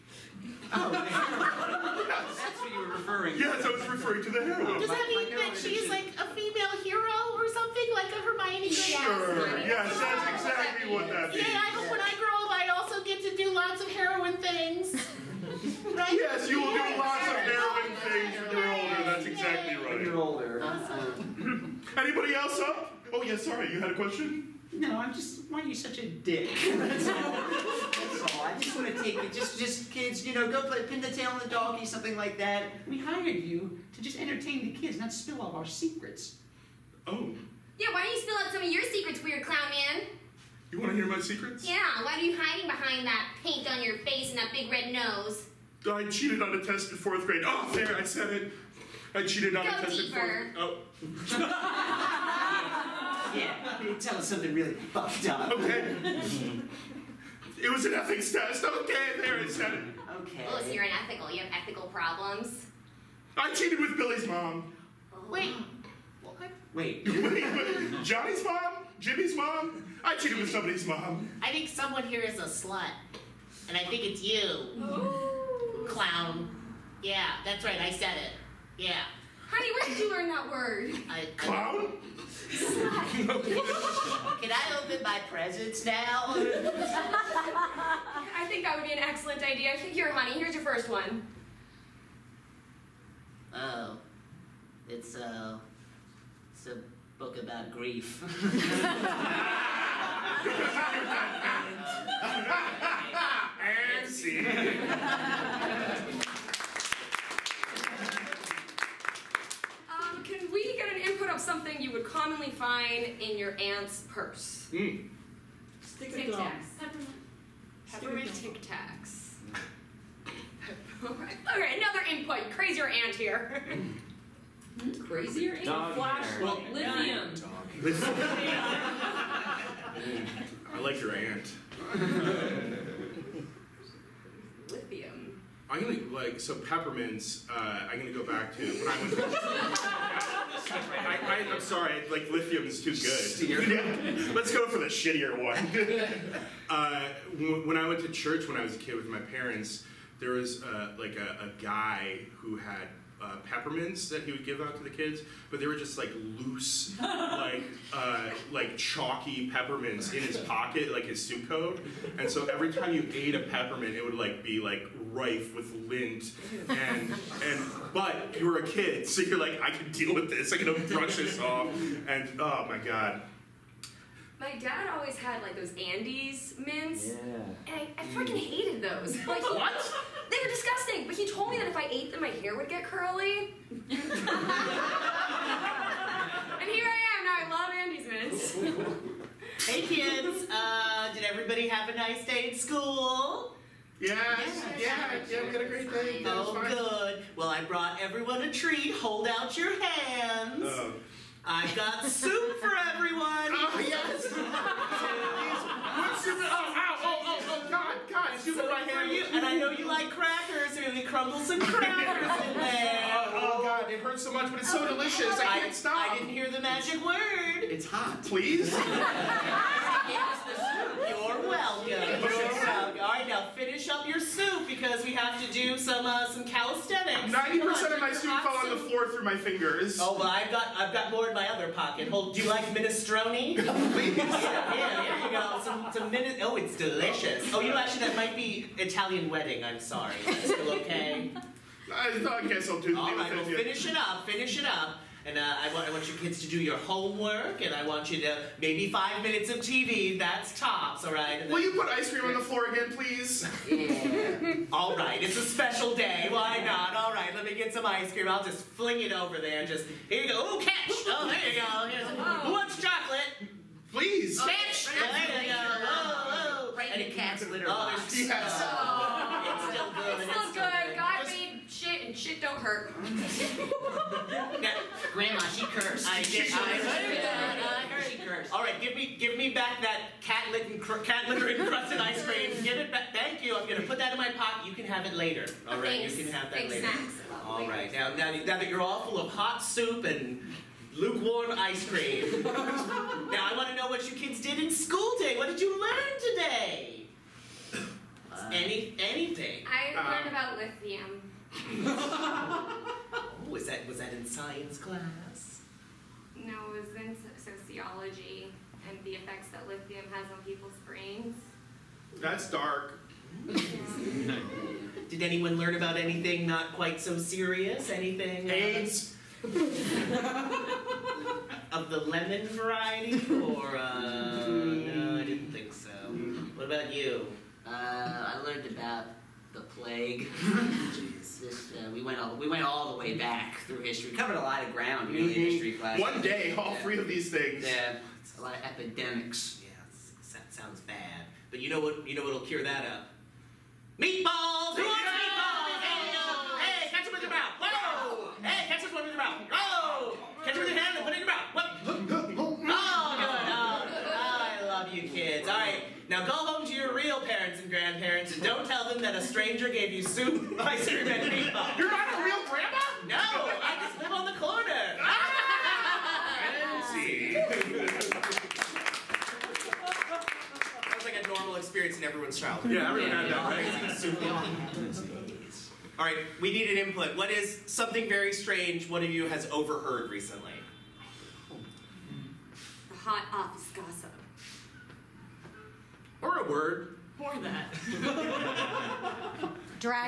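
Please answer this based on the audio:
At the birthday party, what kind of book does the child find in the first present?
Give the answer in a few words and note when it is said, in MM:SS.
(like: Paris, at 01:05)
A book about grief, at 01:36.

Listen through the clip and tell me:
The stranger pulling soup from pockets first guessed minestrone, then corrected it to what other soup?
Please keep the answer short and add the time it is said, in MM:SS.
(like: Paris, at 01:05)
Italian wedding, at 03:58.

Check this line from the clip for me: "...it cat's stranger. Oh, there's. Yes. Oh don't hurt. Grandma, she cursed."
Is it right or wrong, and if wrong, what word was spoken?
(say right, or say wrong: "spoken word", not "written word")
wrong: "litter", not "stranger".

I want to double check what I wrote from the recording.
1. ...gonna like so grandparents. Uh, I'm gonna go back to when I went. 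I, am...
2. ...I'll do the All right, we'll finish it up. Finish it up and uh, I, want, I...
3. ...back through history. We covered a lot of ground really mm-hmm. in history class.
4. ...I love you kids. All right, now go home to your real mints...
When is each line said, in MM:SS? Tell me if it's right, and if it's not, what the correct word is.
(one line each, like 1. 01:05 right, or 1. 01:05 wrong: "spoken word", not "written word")
1. 02:15 wrong: "peppermints", not "grandparents"
2. 04:02 right
3. 05:33 right
4. 05:54 wrong: "parents", not "mints".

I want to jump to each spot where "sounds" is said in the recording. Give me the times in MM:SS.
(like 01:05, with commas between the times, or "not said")
05:40, 06:10.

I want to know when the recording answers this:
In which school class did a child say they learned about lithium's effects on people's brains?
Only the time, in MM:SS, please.
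05:07.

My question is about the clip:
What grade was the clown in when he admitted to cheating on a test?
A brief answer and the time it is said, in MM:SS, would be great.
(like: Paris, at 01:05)
Fourth grade, at 00:46.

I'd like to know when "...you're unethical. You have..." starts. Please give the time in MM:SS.
01:00.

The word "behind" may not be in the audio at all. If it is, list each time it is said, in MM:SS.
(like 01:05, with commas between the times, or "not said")
00:42.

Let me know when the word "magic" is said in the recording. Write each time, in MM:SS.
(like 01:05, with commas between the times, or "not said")
03:36.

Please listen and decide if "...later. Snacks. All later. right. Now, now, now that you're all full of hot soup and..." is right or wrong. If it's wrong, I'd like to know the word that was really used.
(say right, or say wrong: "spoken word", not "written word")
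right.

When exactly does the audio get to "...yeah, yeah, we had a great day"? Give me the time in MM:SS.
03:14.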